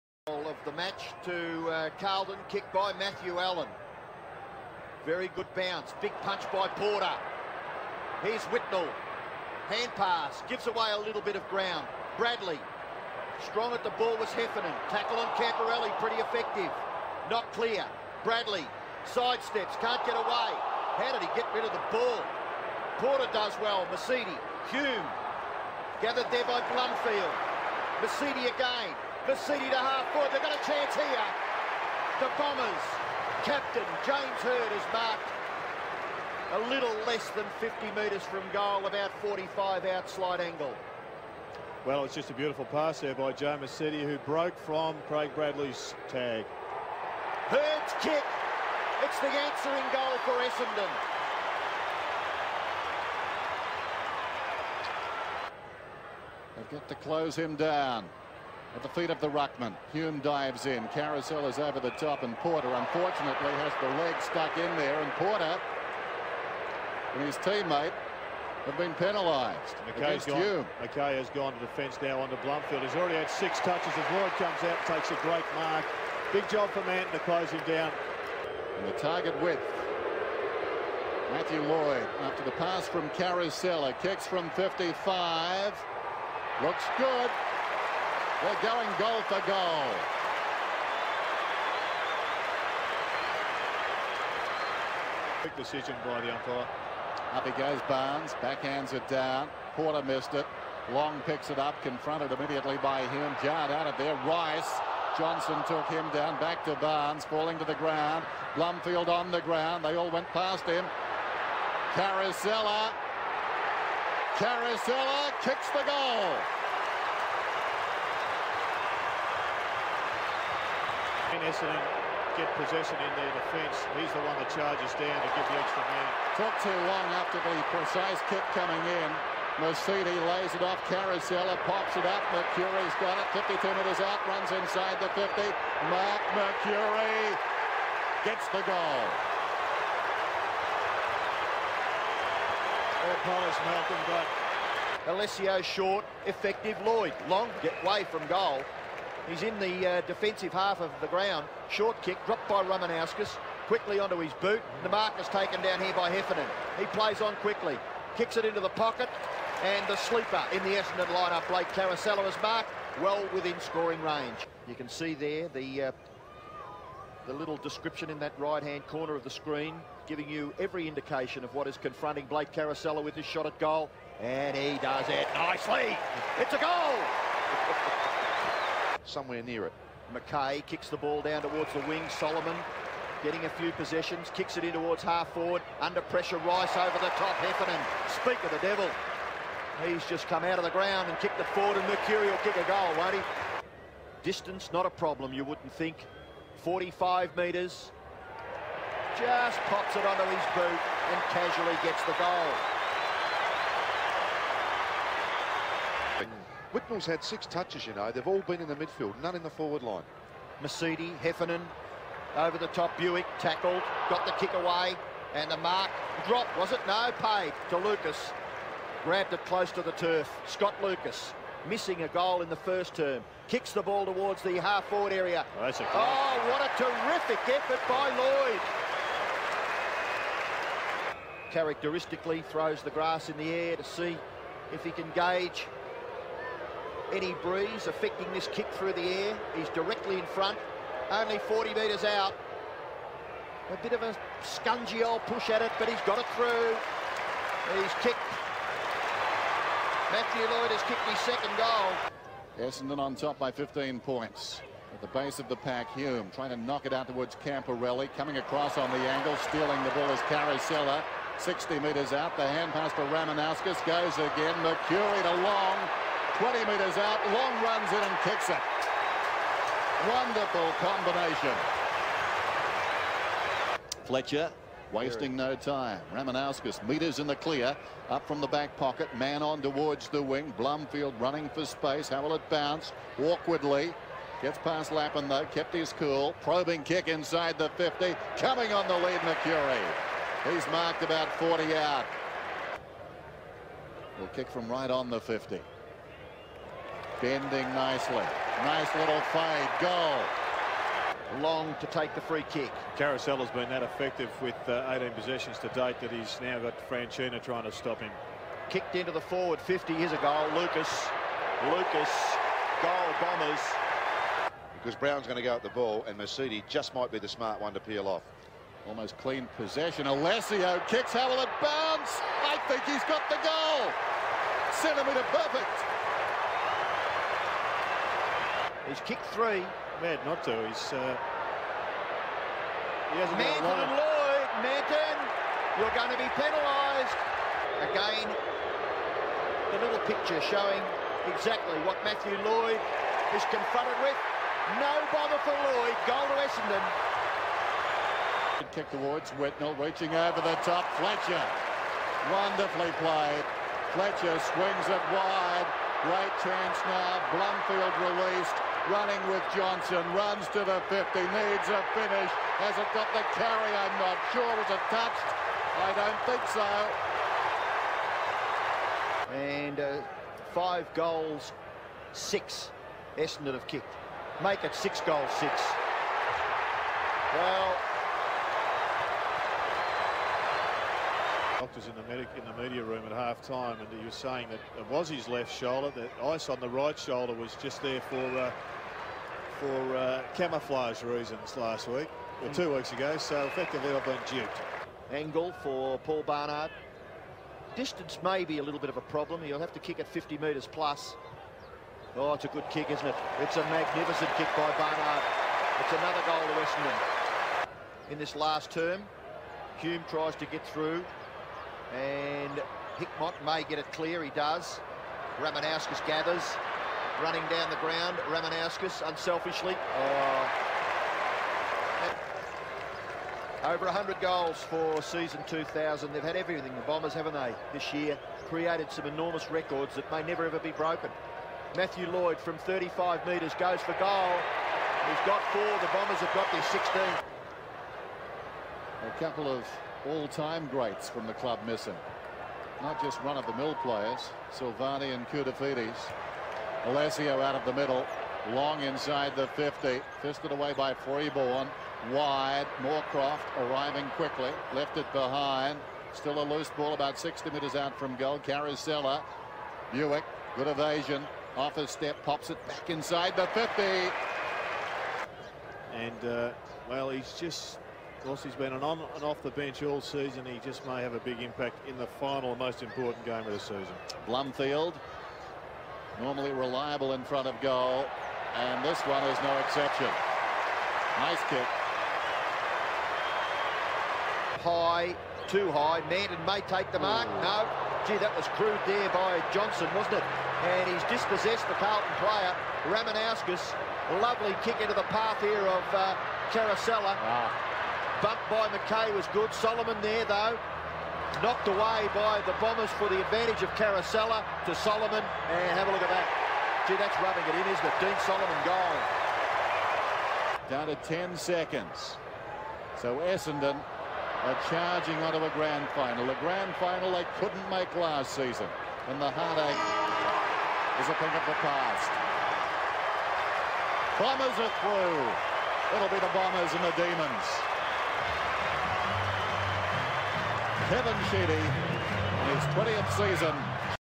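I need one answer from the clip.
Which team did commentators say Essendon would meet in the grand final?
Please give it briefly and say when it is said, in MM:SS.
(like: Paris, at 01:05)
Demons, at 08:46.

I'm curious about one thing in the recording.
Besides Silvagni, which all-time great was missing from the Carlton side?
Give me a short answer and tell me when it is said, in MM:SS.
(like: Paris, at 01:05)
Koutoufides, at 07:25.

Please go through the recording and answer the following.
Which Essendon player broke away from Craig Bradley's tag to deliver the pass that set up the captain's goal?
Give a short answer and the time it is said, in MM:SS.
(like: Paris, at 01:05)
Joe Misiti, at 00:43.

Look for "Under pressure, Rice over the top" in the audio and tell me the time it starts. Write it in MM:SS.
03:05.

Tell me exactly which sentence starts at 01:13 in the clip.
As Lloyd comes out, takes a great mark.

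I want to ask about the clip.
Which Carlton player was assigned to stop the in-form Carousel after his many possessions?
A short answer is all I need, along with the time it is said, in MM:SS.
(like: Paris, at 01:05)
Franchina, at 05:06.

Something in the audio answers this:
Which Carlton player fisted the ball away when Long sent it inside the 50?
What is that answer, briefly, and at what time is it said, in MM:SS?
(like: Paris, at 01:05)
Freeborn, at 07:30.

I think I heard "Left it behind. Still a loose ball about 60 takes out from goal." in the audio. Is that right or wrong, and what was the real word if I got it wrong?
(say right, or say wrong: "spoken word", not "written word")
wrong: "metres", not "takes".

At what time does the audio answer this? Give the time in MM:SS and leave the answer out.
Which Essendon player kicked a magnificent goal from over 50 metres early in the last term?
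06:35.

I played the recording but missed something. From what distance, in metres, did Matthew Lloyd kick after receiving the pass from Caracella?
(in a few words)
55.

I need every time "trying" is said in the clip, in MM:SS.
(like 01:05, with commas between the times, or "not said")
04:16, 05:07.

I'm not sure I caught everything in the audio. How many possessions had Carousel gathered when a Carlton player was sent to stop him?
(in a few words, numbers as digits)
18.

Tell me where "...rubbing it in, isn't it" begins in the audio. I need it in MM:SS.
08:27.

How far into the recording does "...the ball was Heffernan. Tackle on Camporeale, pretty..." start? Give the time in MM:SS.
00:13.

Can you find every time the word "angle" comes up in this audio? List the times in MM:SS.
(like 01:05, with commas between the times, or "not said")
00:40, 04:18, 06:35.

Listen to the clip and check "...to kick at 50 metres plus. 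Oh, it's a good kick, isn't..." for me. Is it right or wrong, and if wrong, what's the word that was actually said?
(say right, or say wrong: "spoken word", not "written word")
right.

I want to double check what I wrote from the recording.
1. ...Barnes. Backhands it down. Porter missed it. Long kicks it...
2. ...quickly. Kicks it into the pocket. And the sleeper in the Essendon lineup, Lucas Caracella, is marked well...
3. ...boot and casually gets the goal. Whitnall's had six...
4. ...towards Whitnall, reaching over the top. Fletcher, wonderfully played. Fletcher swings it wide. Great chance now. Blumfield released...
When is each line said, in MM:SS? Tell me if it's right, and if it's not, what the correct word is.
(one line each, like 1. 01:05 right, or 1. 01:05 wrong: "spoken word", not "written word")
1. 01:37 wrong: "picks", not "kicks"
2. 02:37 wrong: "Blake", not "Lucas"
3. 03:20 right
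4. 05:48 right.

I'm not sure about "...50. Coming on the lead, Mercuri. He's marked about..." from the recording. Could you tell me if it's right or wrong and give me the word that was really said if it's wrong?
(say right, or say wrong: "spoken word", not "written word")
right.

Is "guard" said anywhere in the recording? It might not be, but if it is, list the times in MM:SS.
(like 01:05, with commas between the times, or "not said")
not said.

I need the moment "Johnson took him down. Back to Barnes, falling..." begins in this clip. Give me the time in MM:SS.
01:45.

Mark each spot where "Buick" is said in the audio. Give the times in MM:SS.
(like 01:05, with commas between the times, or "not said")
03:32, 07:39.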